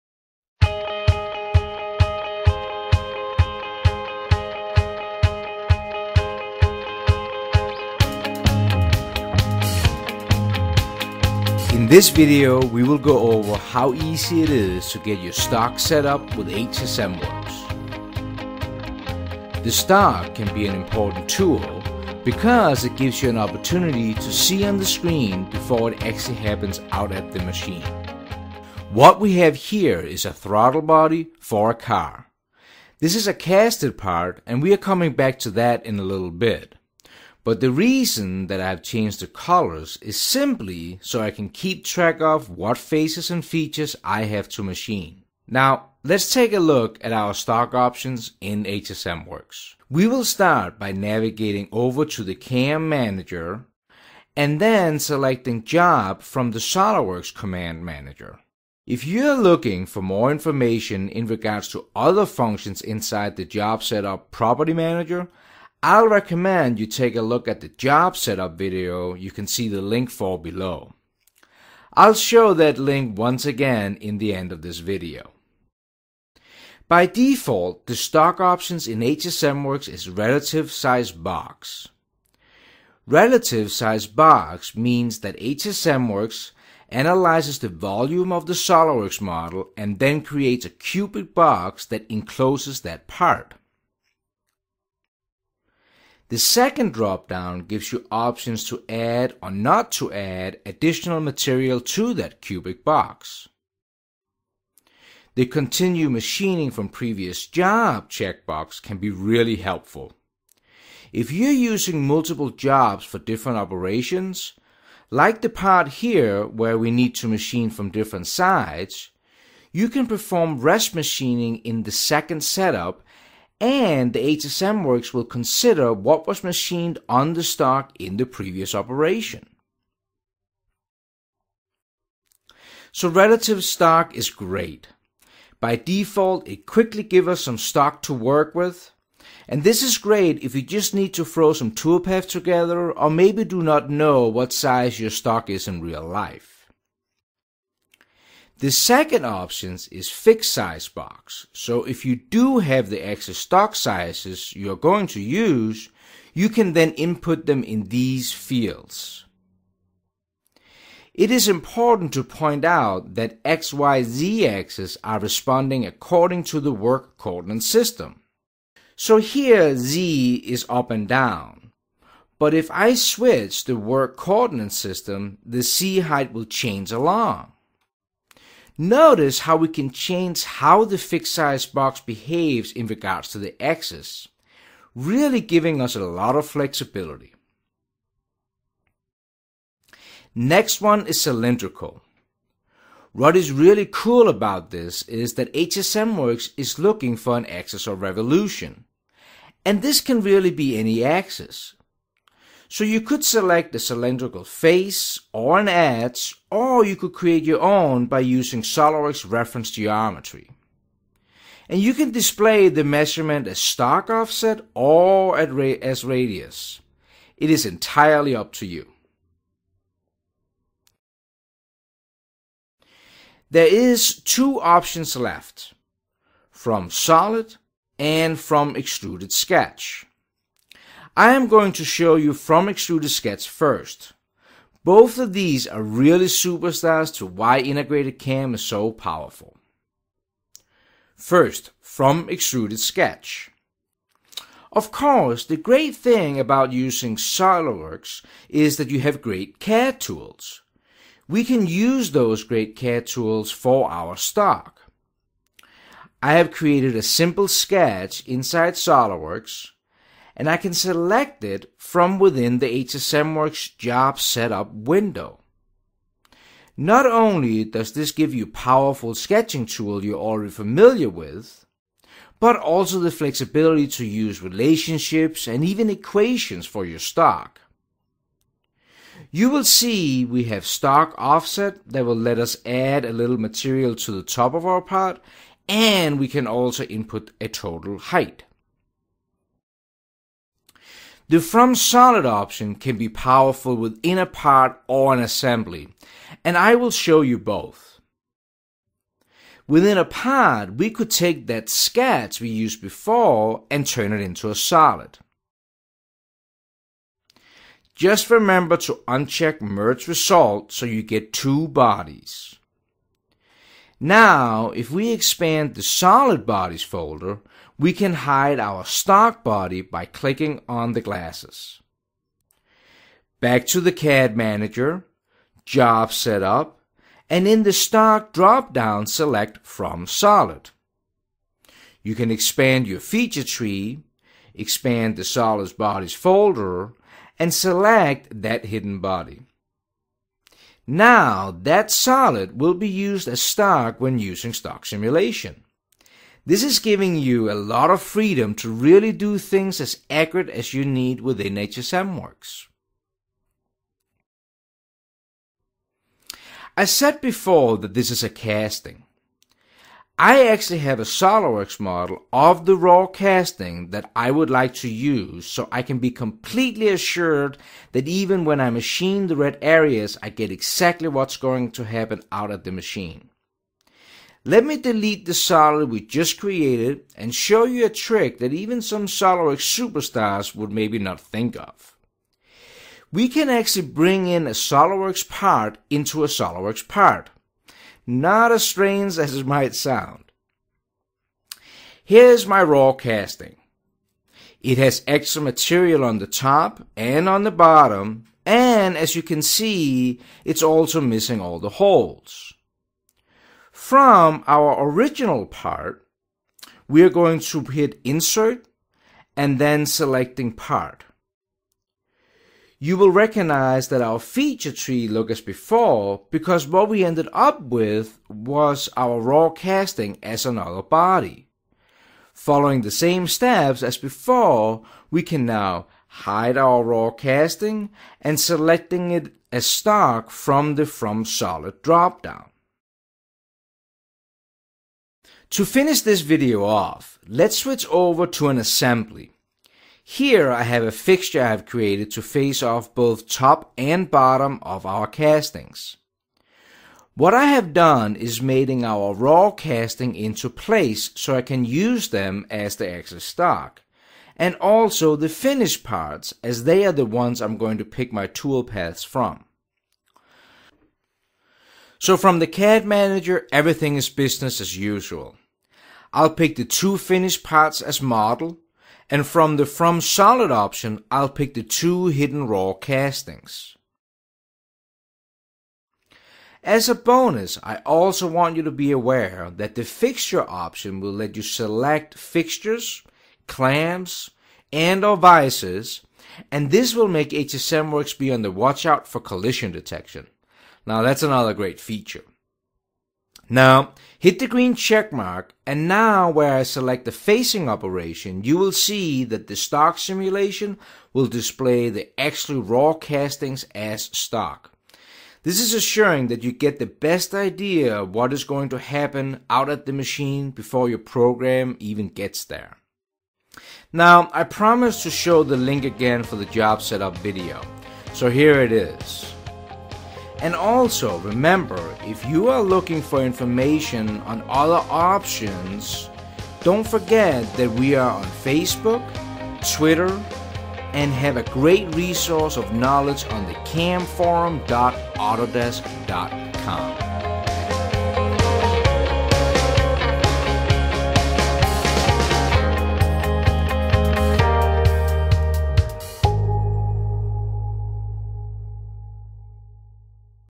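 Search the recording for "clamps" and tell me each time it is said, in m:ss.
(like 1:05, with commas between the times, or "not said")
8:03.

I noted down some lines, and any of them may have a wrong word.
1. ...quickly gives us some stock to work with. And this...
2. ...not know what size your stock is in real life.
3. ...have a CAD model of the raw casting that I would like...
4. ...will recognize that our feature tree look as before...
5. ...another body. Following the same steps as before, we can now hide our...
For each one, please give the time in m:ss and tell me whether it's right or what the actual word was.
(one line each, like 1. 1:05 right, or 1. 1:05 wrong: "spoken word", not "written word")
1. 2:16 right
2. 2:23 right
3. 6:00 wrong: "SolidWorks", not "CAD"
4. 6:52 right
5. 7:00 right.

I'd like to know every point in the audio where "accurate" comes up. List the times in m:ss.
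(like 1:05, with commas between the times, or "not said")
5:50.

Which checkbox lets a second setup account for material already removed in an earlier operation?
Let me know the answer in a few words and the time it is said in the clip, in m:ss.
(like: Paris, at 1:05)
Continue machining from previous job, at 1:45.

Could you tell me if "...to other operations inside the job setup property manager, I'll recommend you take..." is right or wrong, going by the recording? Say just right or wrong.
wrong.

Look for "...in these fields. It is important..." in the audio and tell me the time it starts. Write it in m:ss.
2:37.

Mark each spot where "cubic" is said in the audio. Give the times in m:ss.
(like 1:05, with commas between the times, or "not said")
1:30, 1:42.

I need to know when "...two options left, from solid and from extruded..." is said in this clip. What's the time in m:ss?
3:44.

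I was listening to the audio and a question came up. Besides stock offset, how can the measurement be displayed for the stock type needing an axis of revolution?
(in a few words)
Radius.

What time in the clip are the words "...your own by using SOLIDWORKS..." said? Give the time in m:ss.
3:27.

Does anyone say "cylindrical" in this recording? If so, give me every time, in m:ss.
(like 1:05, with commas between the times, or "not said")
3:11, 3:23.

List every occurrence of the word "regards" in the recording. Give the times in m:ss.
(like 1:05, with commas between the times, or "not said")
1:01, 3:02.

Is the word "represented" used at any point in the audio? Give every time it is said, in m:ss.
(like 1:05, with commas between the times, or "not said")
not said.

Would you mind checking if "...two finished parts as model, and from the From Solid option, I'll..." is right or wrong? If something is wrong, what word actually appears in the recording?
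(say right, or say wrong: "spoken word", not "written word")
right.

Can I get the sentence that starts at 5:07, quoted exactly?
Just remember to uncheck merge result so you get two bodies.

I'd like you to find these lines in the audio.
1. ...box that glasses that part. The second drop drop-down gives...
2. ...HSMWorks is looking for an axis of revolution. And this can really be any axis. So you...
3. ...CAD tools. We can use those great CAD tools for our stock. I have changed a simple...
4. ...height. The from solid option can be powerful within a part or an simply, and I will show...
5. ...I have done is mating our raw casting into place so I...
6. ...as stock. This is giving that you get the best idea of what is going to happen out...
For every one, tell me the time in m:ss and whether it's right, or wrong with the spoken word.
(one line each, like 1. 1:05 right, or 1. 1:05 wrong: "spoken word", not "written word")
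1. 1:31 wrong: "encloses", not "glasses"
2. 3:15 right
3. 4:09 wrong: "created", not "changed"
4. 4:47 wrong: "assembly", not "simply"
5. 7:27 right
6. 8:23 wrong: "assuring", not "giving".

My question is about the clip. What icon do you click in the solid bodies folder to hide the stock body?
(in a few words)
Glasses.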